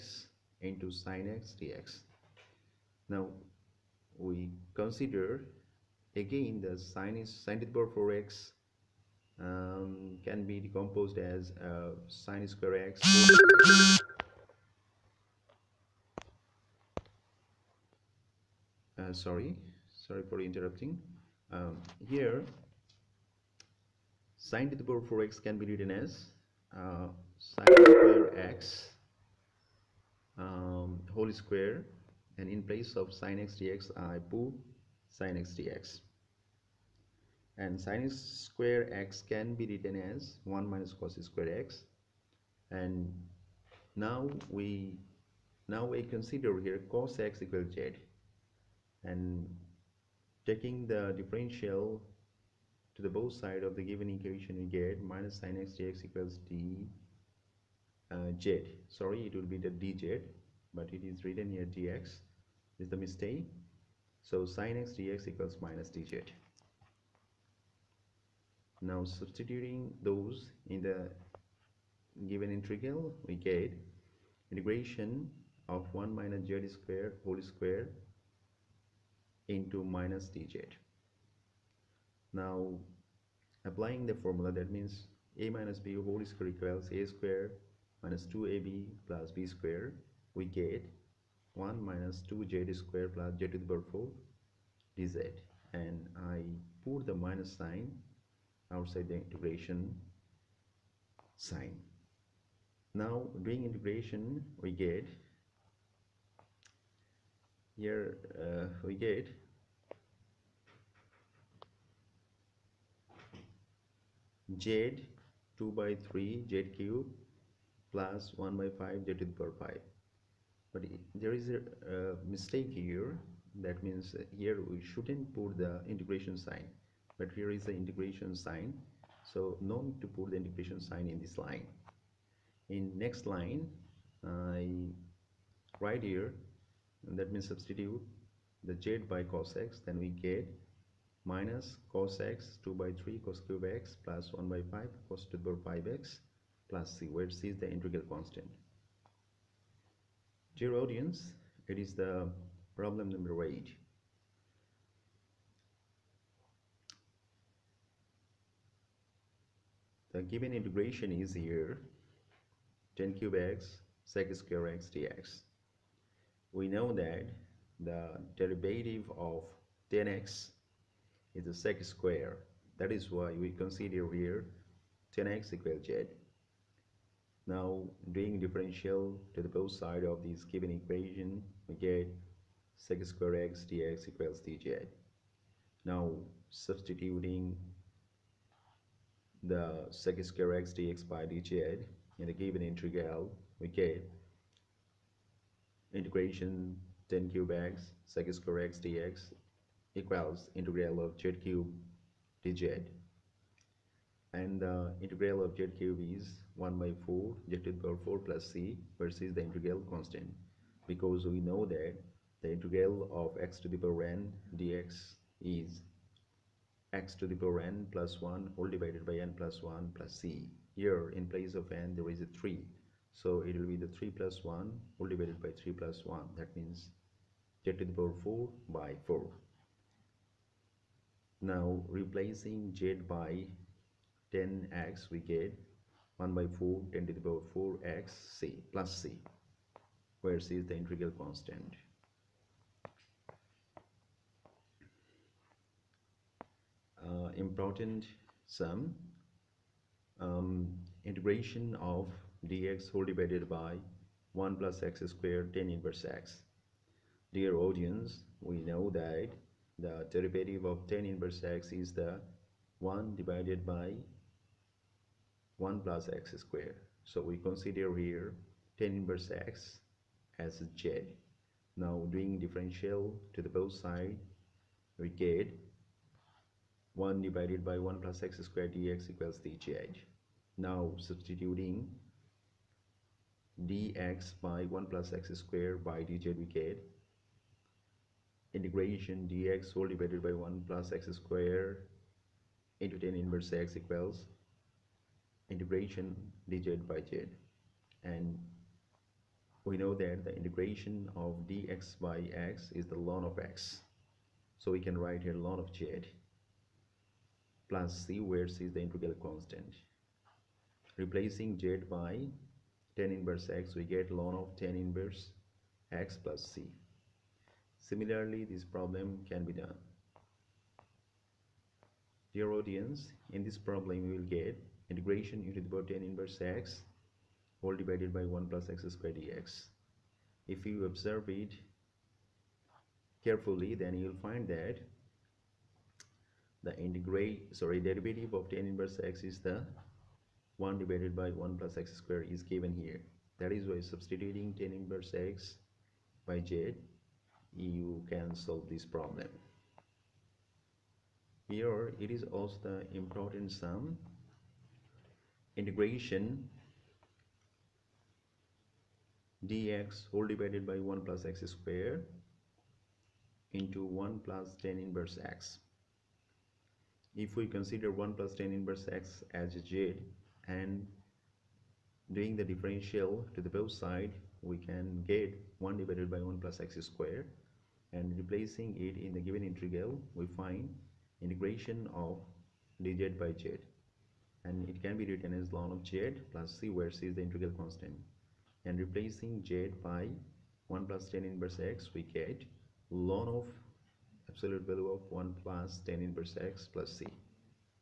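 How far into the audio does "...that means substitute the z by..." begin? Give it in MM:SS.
02:17.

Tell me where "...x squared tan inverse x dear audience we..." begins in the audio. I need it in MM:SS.
04:14.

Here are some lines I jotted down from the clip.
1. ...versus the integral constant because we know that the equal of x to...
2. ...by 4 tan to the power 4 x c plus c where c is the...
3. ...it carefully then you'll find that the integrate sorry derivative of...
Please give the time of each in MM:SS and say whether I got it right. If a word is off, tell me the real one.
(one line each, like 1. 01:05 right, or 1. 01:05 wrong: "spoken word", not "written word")
1. 03:28 wrong: "integral", not "equal"
2. 03:56 right
3. 05:31 right.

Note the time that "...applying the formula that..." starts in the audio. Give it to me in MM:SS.
01:23.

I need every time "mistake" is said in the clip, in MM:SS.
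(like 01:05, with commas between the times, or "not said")
01:02, 02:02.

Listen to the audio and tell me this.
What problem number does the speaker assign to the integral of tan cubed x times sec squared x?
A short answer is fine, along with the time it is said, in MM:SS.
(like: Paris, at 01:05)
8, at 02:32.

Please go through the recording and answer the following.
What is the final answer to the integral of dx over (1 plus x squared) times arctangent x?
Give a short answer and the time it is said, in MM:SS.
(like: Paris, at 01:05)
ln of tan inverse x plus c, at 05:14.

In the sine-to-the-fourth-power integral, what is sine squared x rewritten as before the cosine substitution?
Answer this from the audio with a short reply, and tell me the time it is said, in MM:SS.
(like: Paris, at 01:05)
1 minus cos square x, at 00:40.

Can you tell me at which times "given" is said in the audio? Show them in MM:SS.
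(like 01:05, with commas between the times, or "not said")
00:53, 01:12, 02:40, 03:00, 03:12, 05:42, 06:19.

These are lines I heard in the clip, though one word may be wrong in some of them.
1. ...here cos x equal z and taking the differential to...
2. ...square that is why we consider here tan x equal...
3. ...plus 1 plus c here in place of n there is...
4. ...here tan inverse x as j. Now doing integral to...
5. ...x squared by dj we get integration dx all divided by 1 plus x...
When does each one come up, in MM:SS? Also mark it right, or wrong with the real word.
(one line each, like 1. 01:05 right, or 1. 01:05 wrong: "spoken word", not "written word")
1. 00:46 right
2. 02:51 right
3. 03:39 right
4. 04:27 wrong: "differential", not "integral"
5. 04:45 right.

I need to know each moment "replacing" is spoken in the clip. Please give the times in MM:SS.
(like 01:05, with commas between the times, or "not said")
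03:51, 05:10, 06:18, 06:28.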